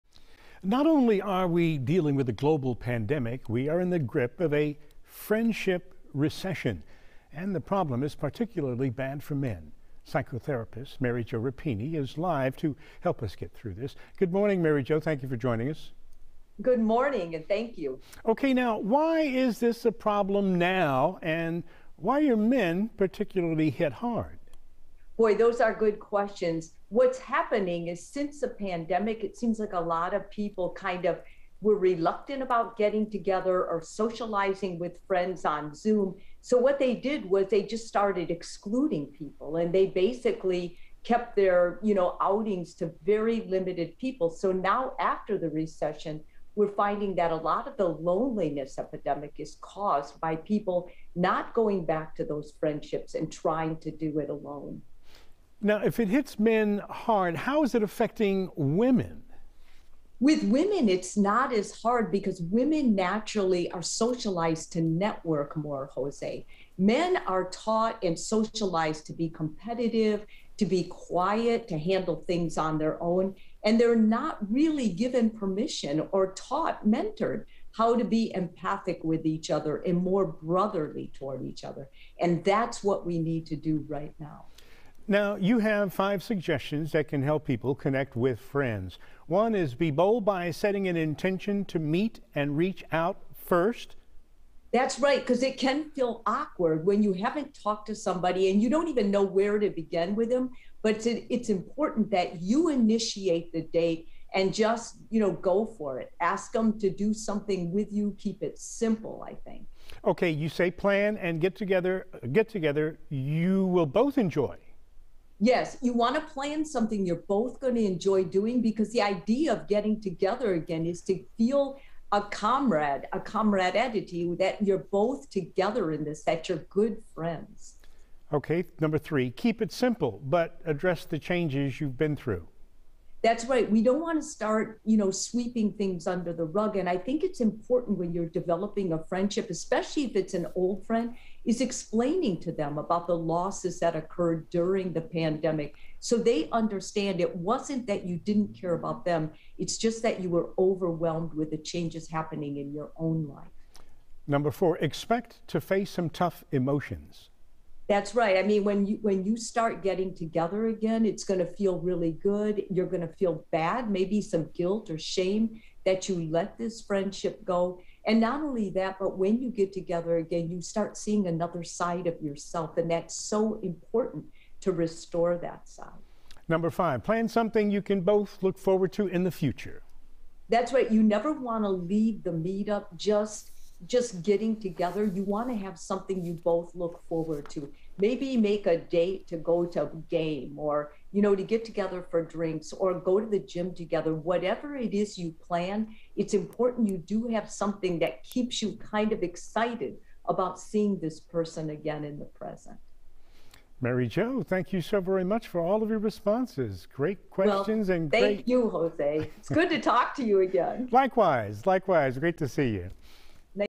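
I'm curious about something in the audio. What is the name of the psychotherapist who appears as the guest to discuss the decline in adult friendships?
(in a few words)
Mary Jo Rapini.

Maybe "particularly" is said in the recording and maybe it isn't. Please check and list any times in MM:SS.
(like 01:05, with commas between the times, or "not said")
00:08, 00:22.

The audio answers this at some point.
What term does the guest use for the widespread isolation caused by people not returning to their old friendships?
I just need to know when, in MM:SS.
00:48.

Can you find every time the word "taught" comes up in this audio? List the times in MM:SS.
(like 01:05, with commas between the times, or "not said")
01:07, 01:16.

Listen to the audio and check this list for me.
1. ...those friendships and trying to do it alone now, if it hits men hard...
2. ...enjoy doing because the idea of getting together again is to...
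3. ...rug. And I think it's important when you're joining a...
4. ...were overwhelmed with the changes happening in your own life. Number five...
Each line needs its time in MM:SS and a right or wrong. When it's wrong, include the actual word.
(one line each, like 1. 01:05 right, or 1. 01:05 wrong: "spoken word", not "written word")
1. 00:52 right
2. 01:57 right
3. 02:16 wrong: "developing", not "joining"
4. 02:30 wrong: "four", not "five".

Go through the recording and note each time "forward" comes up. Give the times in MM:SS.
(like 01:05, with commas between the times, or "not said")
02:58, 03:07.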